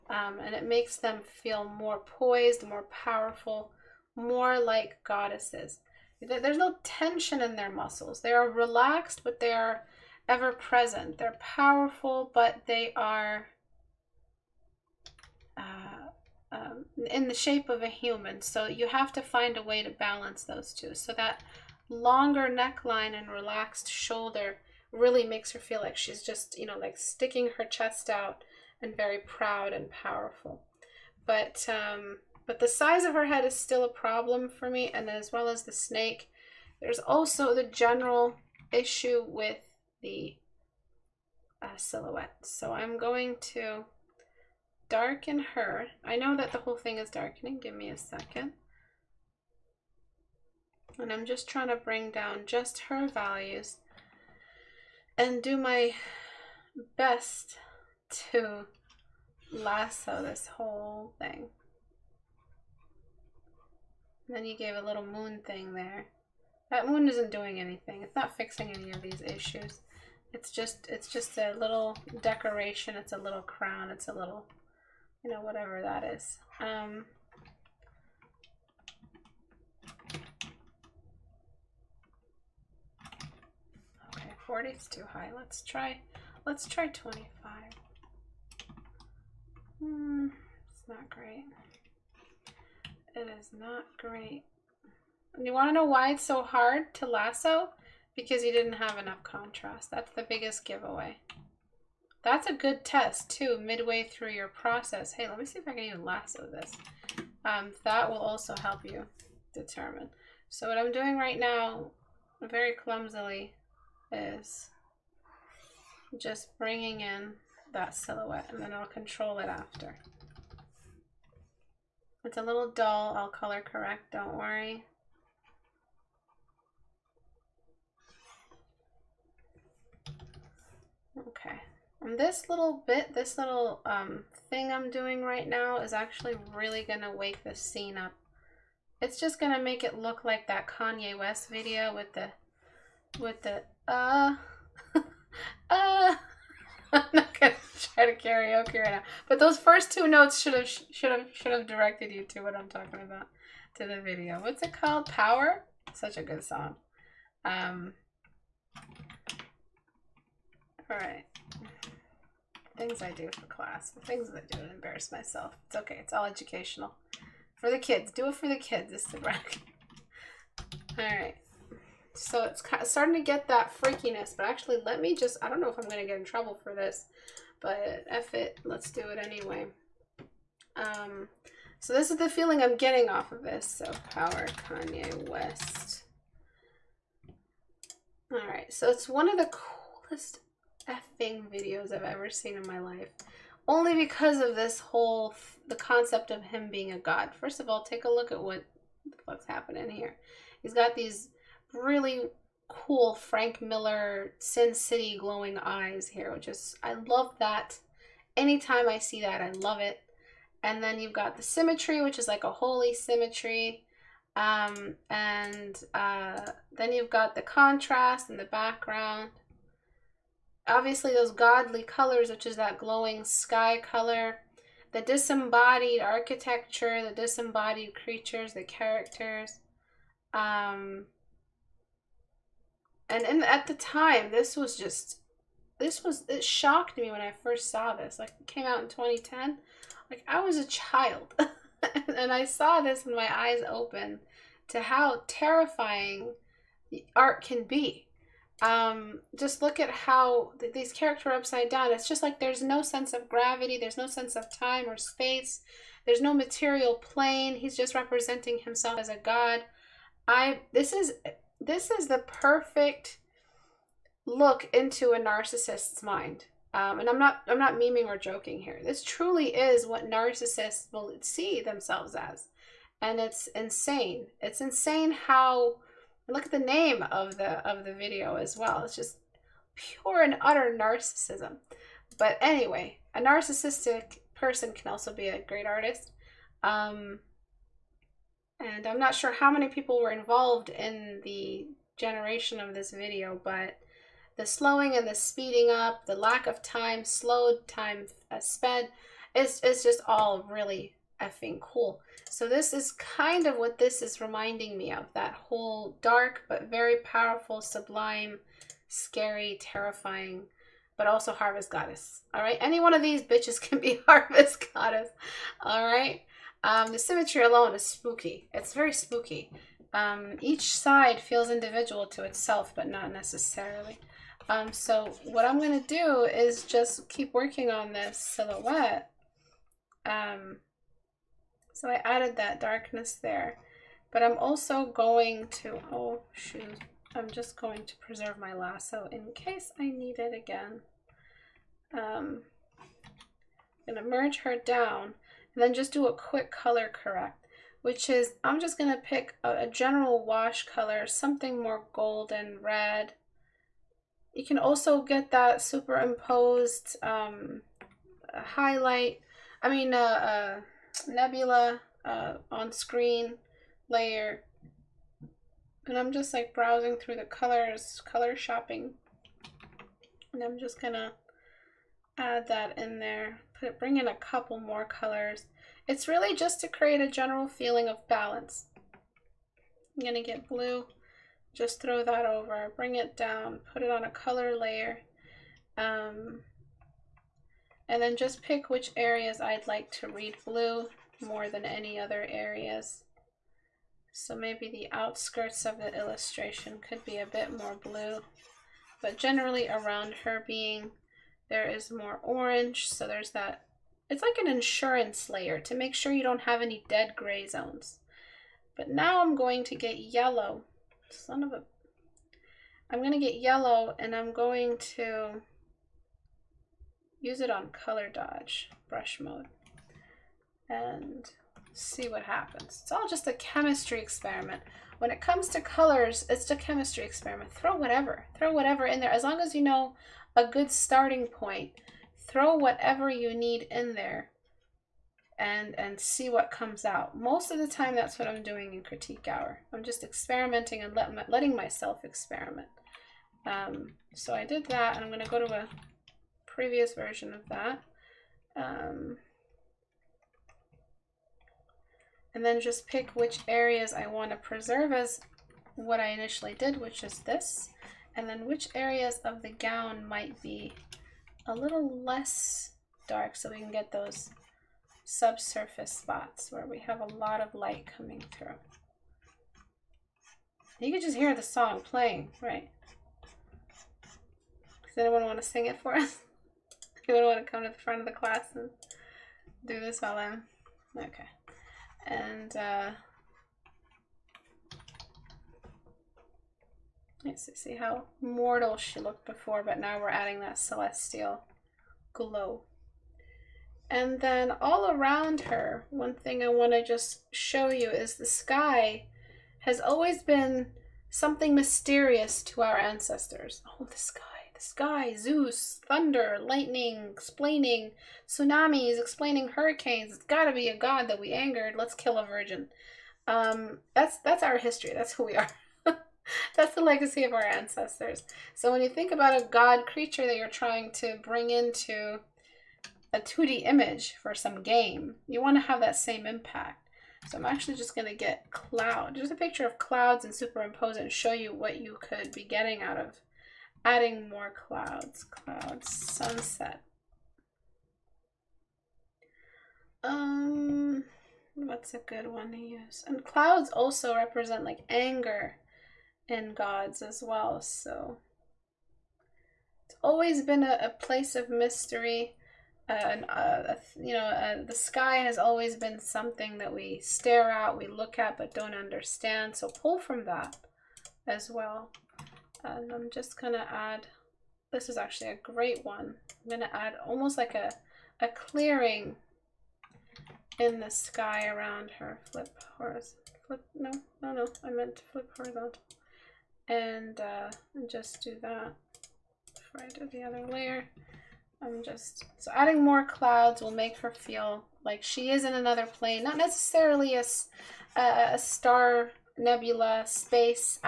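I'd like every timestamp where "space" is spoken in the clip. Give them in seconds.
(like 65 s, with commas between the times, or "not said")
254 s, 590 s.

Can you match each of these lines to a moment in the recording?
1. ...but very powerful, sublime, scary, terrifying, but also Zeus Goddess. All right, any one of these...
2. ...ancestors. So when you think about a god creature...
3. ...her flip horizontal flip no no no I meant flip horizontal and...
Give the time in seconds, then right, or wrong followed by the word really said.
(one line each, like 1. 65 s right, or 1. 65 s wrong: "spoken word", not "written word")
1. 306 s wrong: "Harvest", not "Zeus"
2. 517 s right
3. 571 s right.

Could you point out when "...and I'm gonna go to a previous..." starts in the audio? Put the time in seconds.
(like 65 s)
444 s.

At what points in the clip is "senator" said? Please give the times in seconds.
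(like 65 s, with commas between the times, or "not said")
not said.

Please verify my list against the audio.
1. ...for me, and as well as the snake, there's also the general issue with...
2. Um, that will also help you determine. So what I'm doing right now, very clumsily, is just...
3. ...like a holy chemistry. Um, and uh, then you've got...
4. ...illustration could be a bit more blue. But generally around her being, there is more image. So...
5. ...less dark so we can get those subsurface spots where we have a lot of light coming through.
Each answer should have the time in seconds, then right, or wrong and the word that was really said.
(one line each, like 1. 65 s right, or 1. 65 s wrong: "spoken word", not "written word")
1. 34 s right
2. 107 s right
3. 212 s wrong: "symmetry", not "chemistry"
4. 395 s wrong: "orange", not "image"
5. 462 s right.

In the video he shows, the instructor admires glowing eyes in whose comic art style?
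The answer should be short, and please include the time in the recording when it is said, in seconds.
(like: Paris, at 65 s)
Frank Miller, at 203 s.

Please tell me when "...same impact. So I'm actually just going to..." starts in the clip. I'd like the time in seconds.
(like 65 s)
525 s.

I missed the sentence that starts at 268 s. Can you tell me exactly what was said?
This truly is what narcissists will see themselves as, and it's insane.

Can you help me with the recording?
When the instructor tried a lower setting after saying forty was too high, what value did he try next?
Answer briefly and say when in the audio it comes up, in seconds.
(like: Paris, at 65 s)
25, at 86 s.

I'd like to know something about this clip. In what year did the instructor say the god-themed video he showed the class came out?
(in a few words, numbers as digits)
2010.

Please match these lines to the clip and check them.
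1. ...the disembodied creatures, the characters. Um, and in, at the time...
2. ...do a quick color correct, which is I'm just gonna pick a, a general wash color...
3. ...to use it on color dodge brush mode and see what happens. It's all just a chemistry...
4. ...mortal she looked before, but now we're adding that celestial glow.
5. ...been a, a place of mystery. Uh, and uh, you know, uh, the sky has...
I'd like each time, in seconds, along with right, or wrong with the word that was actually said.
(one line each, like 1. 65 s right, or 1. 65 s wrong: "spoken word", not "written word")
1. 227 s right
2. 345 s right
3. 414 s right
4. 488 s right
5. 550 s right.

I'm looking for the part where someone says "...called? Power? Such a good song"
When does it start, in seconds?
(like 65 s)
154 s.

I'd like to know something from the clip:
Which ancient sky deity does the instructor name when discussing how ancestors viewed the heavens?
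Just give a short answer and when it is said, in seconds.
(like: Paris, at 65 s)
Zeus, at 505 s.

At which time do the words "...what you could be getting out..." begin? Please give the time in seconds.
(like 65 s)
531 s.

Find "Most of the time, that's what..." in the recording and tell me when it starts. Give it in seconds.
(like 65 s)
437 s.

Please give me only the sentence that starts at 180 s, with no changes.
Um, so this is the feeling I'm getting off of this.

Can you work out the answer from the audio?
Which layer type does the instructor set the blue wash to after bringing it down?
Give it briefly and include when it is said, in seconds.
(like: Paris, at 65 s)
color layer, at 384 s.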